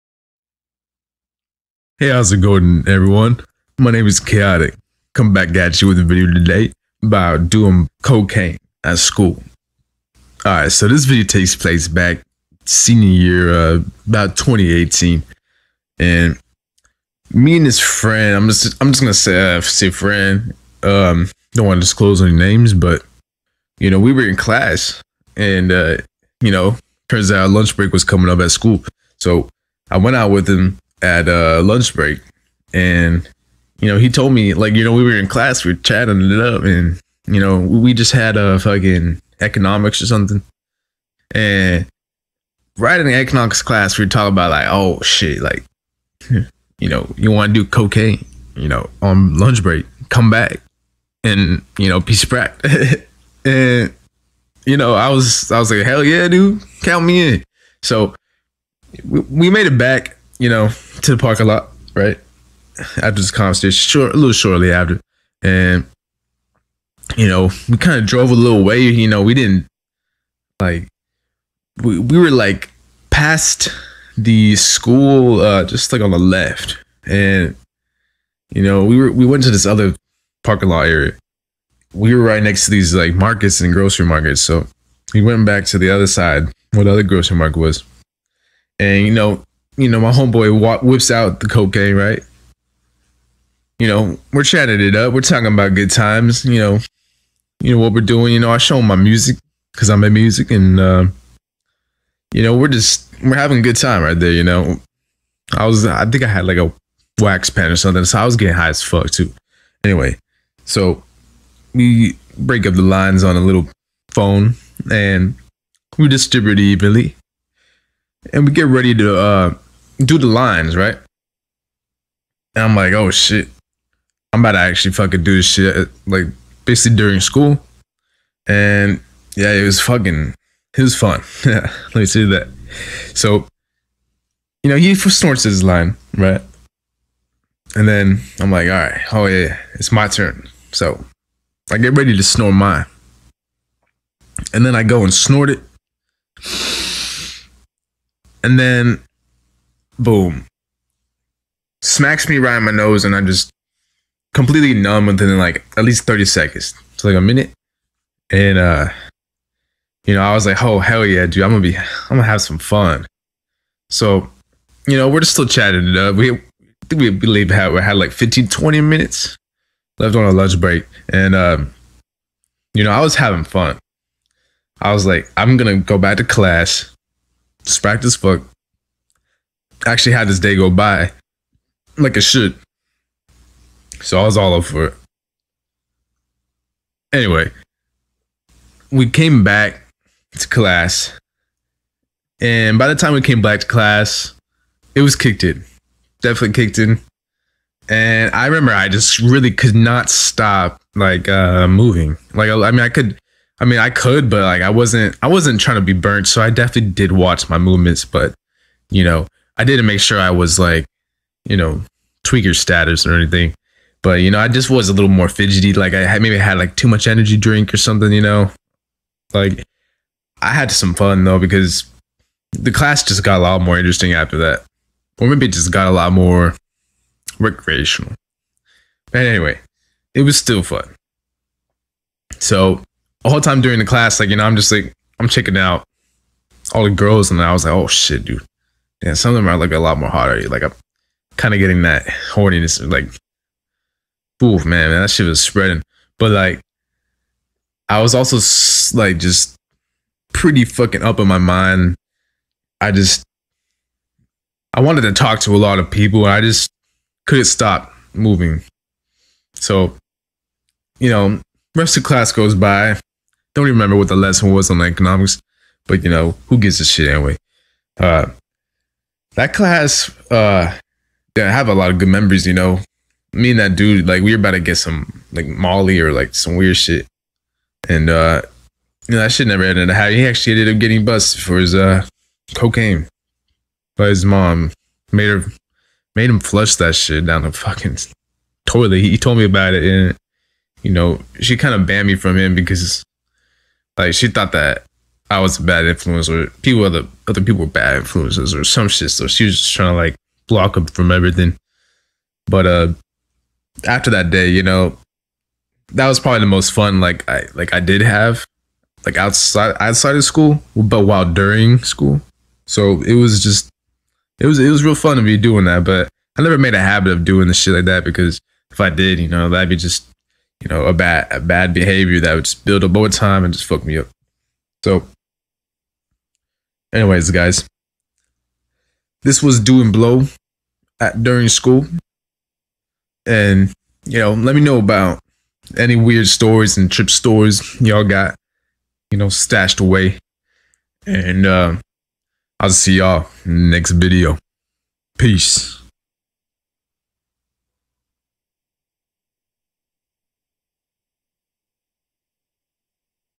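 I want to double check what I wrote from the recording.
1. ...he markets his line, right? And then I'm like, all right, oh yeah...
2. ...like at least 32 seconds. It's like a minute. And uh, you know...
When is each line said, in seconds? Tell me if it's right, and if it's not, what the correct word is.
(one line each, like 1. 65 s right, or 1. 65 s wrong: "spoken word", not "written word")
1. 134 s wrong: "snorts", not "markets"
2. 155 s wrong: "30", not "32".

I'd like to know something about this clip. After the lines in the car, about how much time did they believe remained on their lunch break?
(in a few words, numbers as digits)
15 to 20 minutes.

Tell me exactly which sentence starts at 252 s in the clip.
I just I wanted to talk to a lot of people, and I just couldn't stop moving.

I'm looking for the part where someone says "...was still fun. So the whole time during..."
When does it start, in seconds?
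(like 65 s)
230 s.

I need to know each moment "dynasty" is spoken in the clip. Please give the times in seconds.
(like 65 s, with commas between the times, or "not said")
not said.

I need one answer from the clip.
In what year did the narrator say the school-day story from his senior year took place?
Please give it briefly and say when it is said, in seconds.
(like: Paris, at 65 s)
2018, at 14 s.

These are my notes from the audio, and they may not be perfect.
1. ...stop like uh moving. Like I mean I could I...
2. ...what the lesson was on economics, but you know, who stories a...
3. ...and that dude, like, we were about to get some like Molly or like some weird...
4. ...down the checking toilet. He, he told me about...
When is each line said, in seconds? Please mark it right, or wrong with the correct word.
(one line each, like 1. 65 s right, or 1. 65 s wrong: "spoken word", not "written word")
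1. 200 s right
2. 263 s wrong: "gives", not "stories"
3. 273 s right
4. 287 s wrong: "fucking", not "checking".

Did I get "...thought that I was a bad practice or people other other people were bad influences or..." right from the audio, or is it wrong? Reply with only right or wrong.
wrong.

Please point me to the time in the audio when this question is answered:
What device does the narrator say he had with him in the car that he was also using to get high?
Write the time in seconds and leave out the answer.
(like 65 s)
107 s.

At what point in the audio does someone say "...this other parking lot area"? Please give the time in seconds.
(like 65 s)
79 s.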